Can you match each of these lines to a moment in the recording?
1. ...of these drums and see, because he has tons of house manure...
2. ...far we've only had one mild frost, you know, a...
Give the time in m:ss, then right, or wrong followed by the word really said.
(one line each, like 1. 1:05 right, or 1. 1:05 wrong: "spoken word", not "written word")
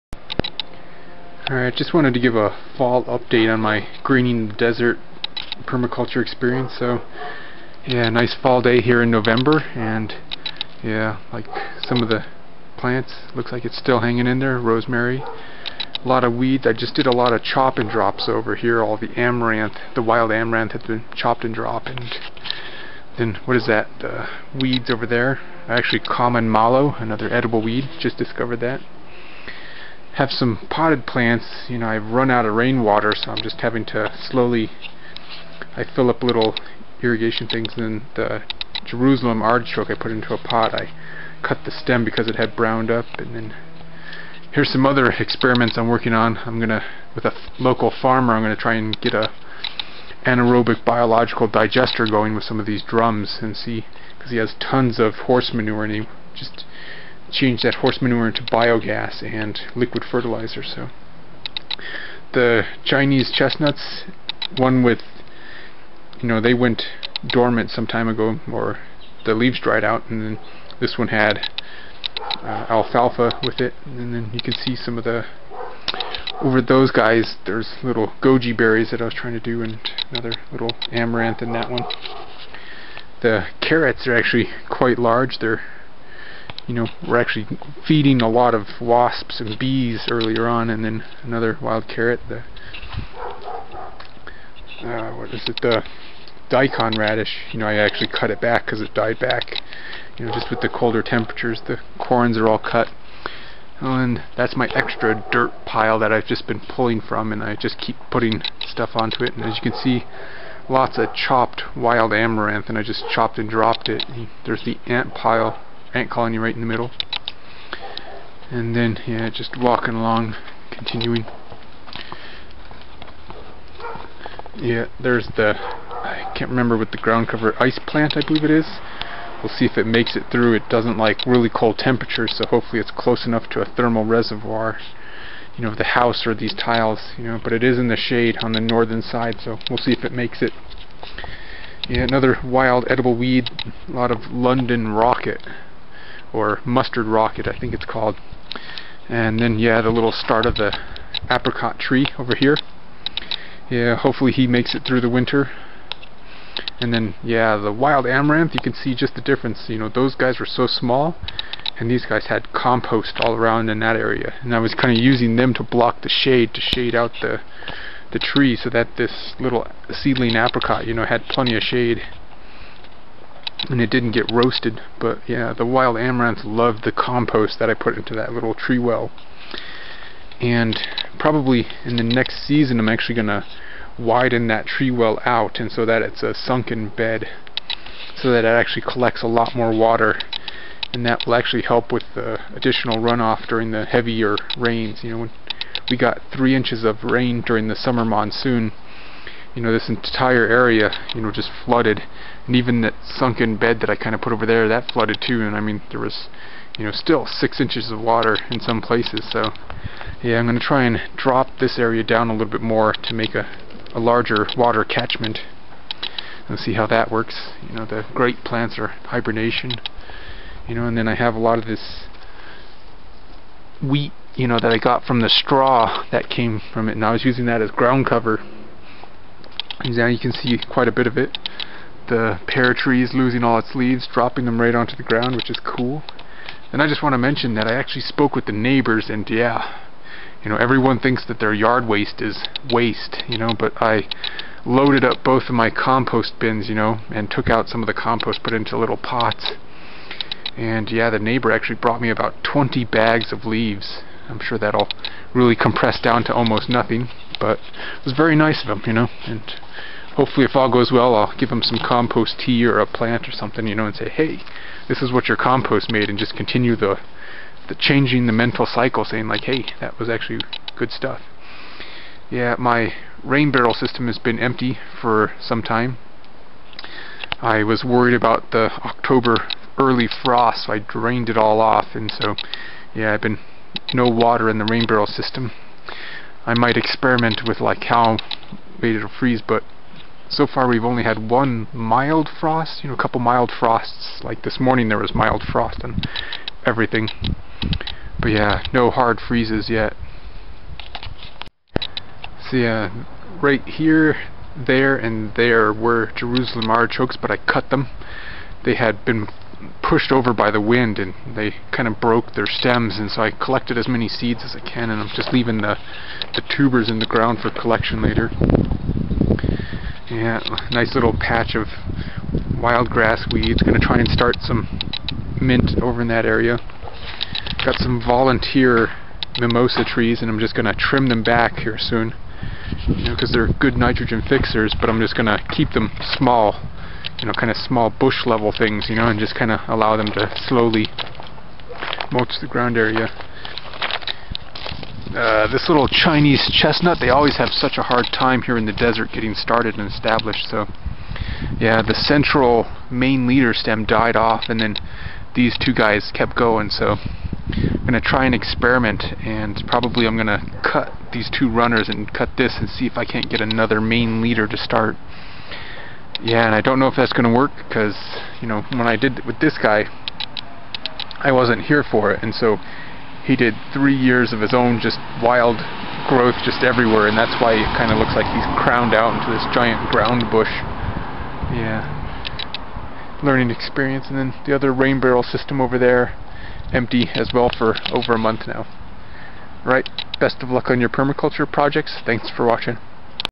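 1. 0:52 wrong: "horse", not "house"
2. 4:50 right.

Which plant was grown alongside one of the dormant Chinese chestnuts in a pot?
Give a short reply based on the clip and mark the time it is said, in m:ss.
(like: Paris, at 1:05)
Alfalfa, at 1:12.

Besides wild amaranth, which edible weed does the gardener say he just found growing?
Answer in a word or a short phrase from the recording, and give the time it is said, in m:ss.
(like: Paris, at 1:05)
Common mallow, at 0:25.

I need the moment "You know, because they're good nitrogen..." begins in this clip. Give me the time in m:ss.
5:32.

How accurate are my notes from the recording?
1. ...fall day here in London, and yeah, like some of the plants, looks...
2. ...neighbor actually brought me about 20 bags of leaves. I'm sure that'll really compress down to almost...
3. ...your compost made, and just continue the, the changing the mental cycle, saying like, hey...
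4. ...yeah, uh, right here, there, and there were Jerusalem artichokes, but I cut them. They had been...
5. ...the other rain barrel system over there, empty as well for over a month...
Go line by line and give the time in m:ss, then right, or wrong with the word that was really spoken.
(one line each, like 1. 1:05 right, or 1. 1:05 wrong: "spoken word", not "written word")
1. 0:08 wrong: "November", not "London"
2. 4:11 right
3. 4:25 right
4. 5:02 right
5. 6:24 right.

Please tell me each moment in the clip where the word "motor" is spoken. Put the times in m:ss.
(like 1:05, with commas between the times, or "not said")
not said.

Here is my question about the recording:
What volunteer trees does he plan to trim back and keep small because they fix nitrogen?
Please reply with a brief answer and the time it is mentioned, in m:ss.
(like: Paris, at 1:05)
Mimosa trees, at 5:29.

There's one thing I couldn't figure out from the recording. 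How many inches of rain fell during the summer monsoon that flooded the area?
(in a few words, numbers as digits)
3 inches.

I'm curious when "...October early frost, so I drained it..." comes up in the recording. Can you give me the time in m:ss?
4:38.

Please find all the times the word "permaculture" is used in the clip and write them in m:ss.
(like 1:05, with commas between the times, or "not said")
0:05, 6:30.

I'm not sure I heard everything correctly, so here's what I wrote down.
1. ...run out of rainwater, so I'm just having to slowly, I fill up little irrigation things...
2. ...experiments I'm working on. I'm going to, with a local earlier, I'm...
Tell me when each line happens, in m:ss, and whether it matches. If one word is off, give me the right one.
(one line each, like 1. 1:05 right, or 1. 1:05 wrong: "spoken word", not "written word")
1. 0:32 right
2. 0:45 wrong: "farmer", not "earlier".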